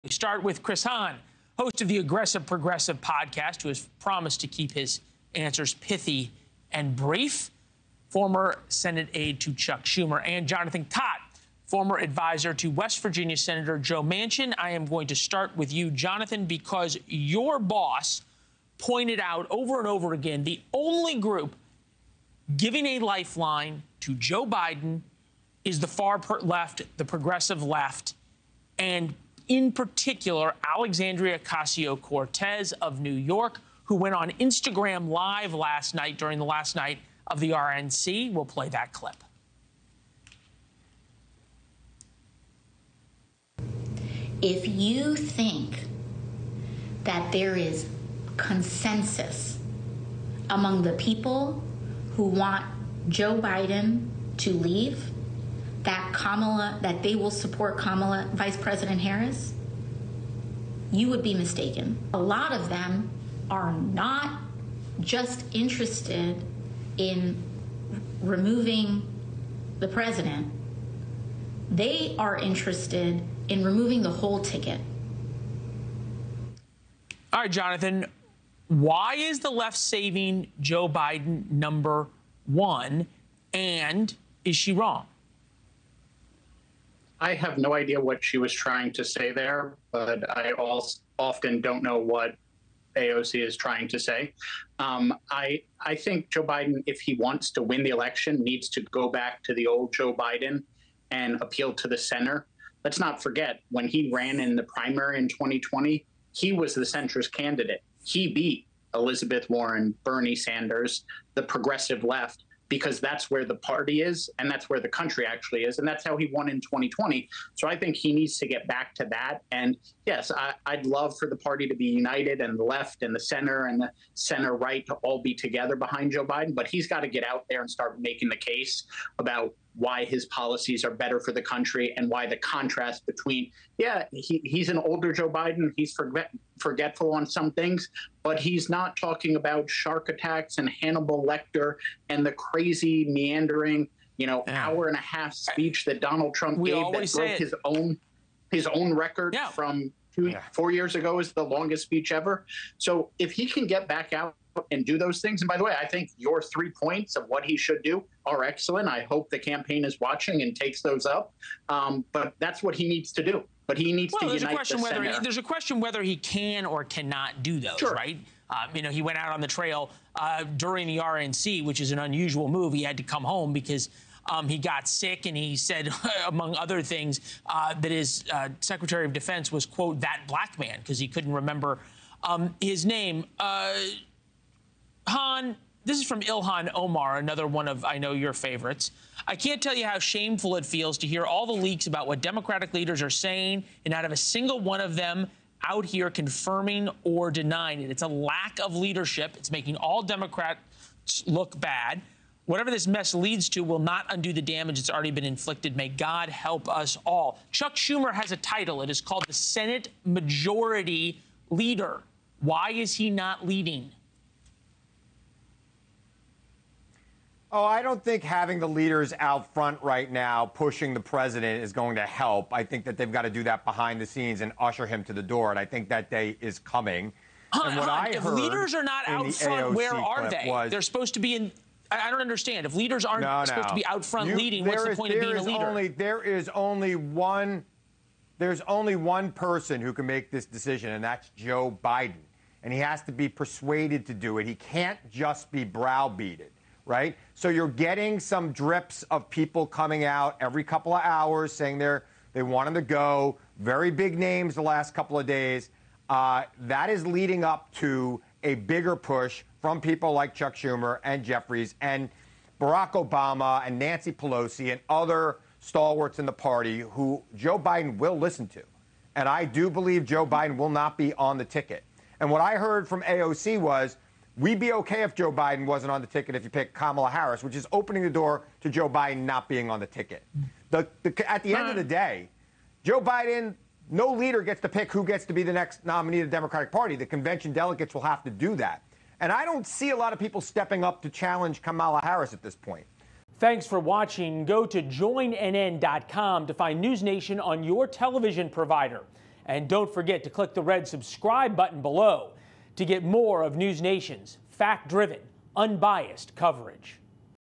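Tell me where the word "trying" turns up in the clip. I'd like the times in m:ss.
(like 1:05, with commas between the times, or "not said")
1:28, 1:33.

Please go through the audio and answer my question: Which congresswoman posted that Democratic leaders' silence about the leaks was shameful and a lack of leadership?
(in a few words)
Ilhan Omar.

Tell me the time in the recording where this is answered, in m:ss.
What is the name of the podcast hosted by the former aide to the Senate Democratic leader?
0:01.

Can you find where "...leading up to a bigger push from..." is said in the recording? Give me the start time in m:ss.
4:17.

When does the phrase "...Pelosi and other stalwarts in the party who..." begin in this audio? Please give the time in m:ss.
4:24.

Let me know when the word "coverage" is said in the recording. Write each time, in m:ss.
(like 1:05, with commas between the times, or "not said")
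5:06.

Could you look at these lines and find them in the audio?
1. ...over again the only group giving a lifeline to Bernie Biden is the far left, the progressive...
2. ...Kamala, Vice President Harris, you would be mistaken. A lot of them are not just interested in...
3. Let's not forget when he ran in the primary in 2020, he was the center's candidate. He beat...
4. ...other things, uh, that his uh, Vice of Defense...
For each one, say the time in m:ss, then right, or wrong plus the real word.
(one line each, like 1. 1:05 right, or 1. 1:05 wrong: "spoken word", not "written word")
1. 0:19 wrong: "Joe", not "Bernie"
2. 0:57 right
3. 1:42 right
4. 2:56 wrong: "Secretary", not "Vice".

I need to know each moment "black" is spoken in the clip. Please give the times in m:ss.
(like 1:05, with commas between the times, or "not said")
3:00.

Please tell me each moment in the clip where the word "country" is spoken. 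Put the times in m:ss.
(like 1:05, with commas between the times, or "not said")
1:54, 2:11.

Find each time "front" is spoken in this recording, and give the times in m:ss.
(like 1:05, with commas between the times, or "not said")
3:39, 3:49, 3:54.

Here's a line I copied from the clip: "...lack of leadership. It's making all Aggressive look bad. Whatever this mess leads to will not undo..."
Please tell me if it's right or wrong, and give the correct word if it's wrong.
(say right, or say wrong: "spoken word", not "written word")
wrong: "Democrats", not "Aggressive".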